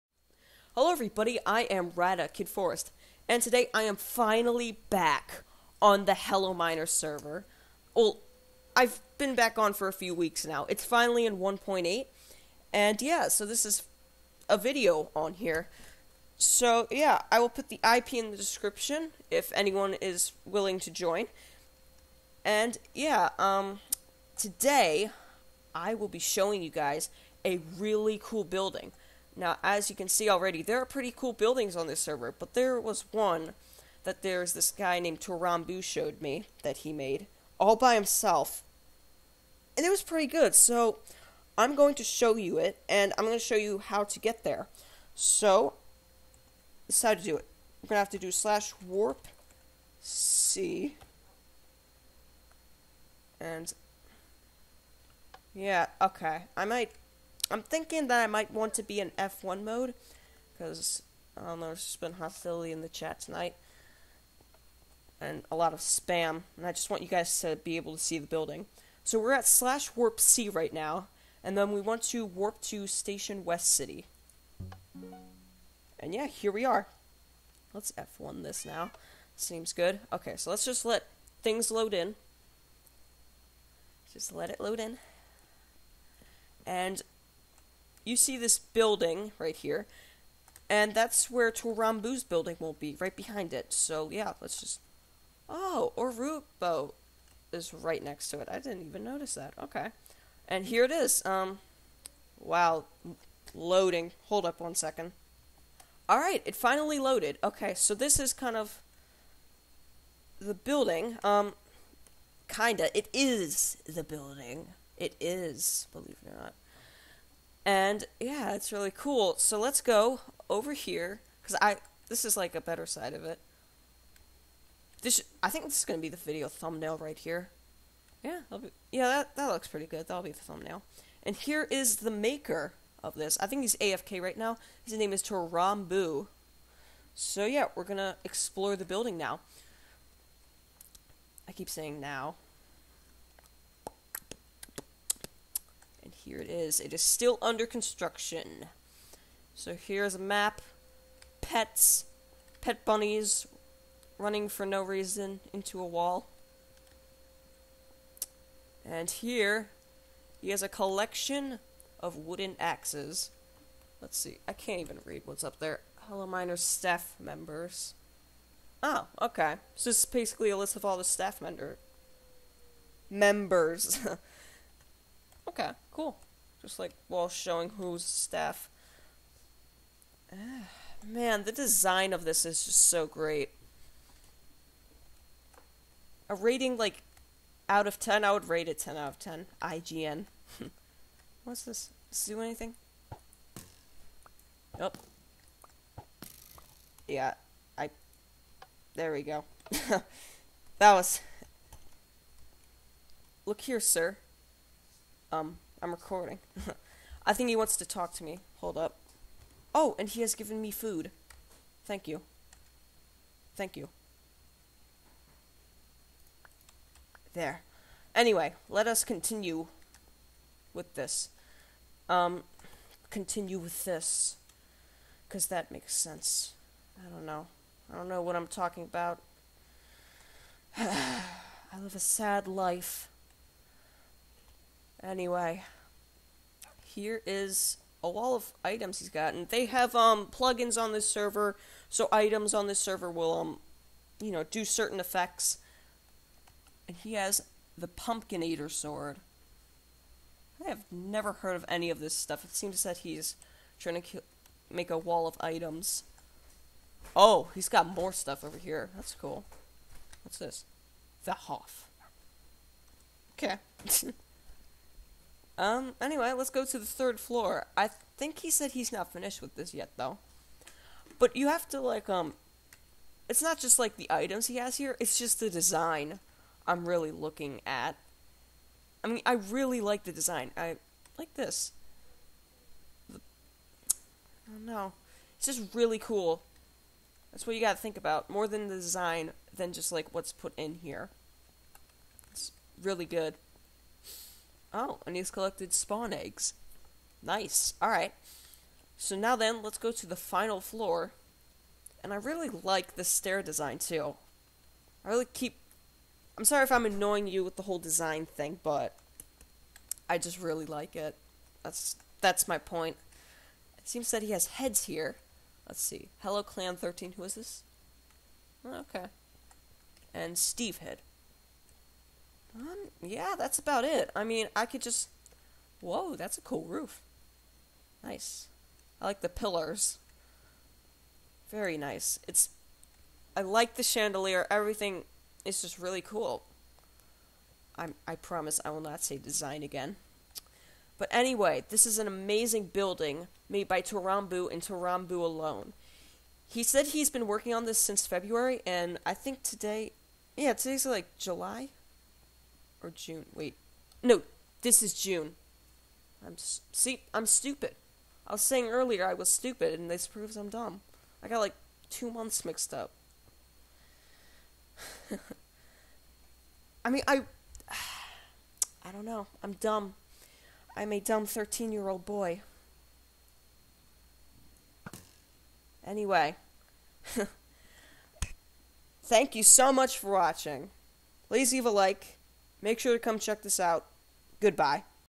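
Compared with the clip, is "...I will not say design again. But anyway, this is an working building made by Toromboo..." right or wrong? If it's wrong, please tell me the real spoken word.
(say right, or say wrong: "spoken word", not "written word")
wrong: "amazing", not "working".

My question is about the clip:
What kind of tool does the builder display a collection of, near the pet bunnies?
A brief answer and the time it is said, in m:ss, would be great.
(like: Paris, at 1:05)
Wooden axes, at 2:42.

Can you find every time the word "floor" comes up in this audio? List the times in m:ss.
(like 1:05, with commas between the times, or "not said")
4:27, 5:00.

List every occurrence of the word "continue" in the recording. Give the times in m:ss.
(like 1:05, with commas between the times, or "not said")
3:39, 3:43.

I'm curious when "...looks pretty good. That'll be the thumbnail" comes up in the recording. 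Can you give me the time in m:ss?
2:09.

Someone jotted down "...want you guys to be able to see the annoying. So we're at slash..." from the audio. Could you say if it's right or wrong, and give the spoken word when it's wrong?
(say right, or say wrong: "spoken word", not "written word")
wrong: "building", not "annoying".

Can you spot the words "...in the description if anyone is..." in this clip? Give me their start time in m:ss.
0:18.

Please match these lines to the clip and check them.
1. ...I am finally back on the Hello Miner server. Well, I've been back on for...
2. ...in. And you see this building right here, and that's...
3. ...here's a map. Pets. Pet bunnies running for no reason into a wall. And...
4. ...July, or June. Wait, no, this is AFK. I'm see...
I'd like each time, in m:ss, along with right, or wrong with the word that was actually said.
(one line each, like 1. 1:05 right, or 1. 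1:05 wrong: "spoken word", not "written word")
1. 0:03 right
2. 1:24 right
3. 2:29 right
4. 5:51 wrong: "June", not "AFK".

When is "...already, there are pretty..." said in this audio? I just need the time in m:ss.
0:30.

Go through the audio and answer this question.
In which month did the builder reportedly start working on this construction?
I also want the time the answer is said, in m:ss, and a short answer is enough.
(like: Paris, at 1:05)
February, at 5:48.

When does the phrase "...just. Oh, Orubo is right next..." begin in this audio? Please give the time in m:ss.
1:34.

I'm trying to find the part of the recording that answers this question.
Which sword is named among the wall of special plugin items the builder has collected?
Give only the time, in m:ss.
4:07.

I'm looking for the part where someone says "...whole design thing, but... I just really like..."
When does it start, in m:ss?
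5:07.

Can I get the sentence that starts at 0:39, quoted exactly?
And it was pretty good, so I'm going to show you it, and I'm going to show you how to get there.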